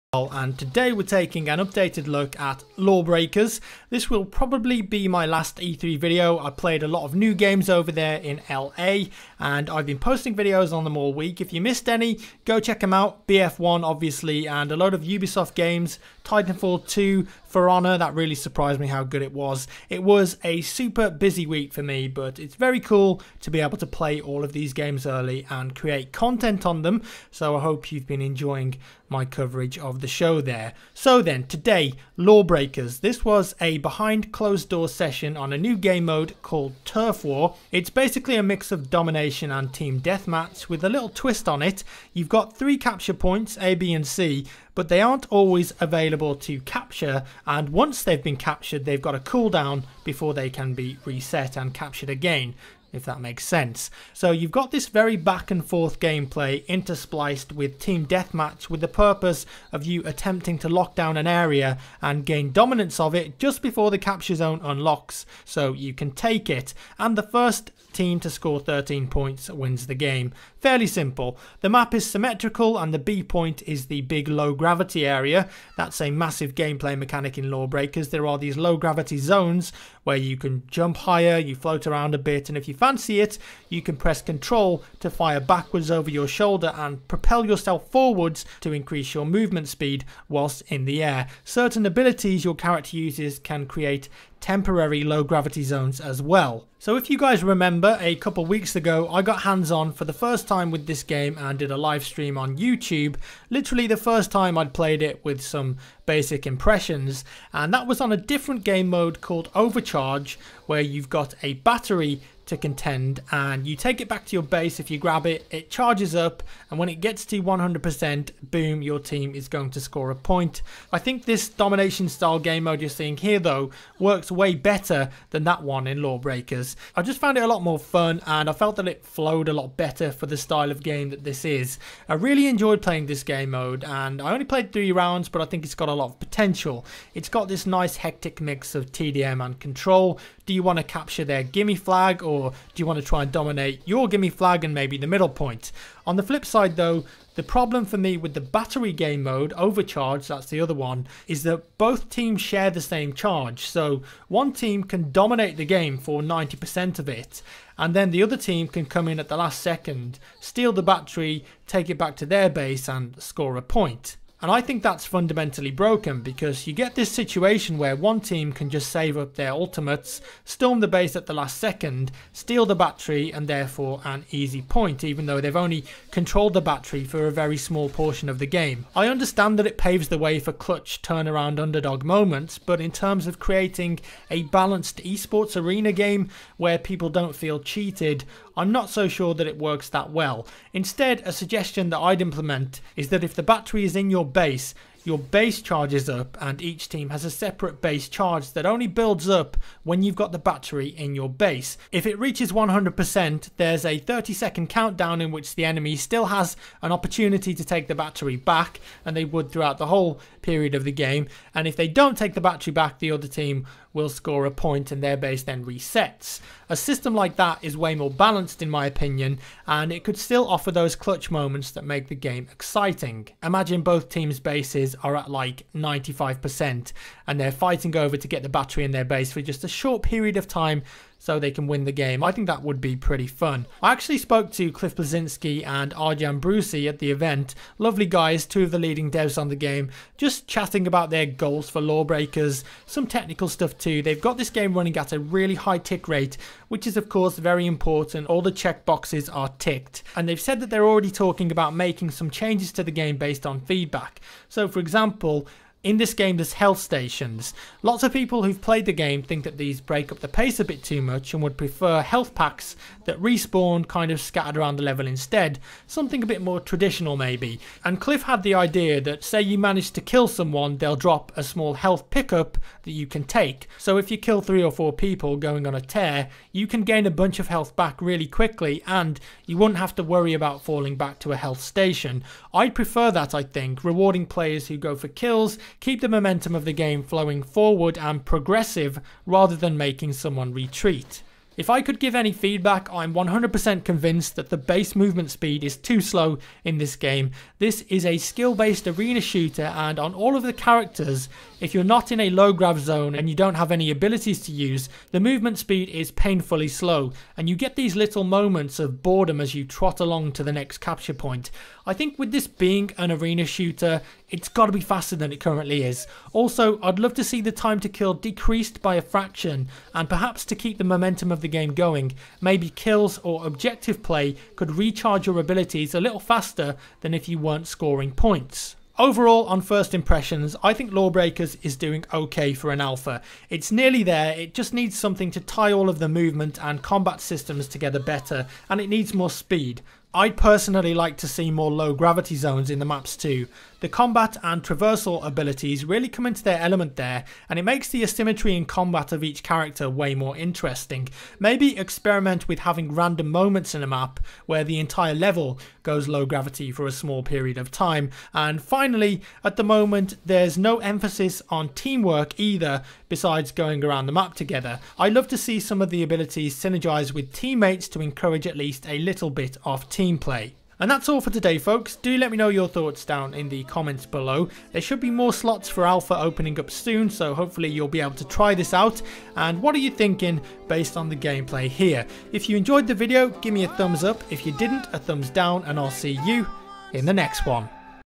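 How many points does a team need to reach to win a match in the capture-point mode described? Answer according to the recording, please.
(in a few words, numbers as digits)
13.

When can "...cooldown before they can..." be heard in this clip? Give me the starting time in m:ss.
0:49.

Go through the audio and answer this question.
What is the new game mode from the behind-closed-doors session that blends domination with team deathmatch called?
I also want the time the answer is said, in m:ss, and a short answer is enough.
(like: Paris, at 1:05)
Turf War, at 0:36.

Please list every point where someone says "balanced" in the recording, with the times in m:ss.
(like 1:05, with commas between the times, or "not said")
3:04, 3:38.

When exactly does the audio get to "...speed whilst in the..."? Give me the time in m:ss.
1:29.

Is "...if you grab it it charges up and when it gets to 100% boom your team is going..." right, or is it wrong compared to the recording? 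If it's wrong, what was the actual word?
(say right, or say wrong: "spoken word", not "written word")
right.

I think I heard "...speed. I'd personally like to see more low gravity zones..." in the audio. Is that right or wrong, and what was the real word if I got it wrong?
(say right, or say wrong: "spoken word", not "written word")
right.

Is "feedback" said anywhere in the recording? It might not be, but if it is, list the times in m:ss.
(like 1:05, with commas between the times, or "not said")
4:13, 4:52.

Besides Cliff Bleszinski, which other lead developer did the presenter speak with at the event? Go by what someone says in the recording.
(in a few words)
Arjan Brussee.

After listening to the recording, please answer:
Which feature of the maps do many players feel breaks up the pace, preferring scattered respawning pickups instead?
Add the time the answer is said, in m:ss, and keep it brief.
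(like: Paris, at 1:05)
health stations, at 4:16.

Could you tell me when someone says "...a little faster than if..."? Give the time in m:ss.
5:25.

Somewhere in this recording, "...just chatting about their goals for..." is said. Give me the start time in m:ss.
4:00.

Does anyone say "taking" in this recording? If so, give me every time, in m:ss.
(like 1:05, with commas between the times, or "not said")
0:01.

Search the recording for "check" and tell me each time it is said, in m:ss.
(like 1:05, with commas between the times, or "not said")
0:12, 4:08.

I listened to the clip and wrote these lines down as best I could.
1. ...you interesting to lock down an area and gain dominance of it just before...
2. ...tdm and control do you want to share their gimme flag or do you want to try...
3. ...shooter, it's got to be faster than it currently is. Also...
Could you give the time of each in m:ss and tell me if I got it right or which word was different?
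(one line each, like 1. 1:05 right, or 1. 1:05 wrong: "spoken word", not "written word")
1. 0:59 wrong: "attempting", not "interesting"
2. 2:18 wrong: "capture", not "share"
3. 5:13 right.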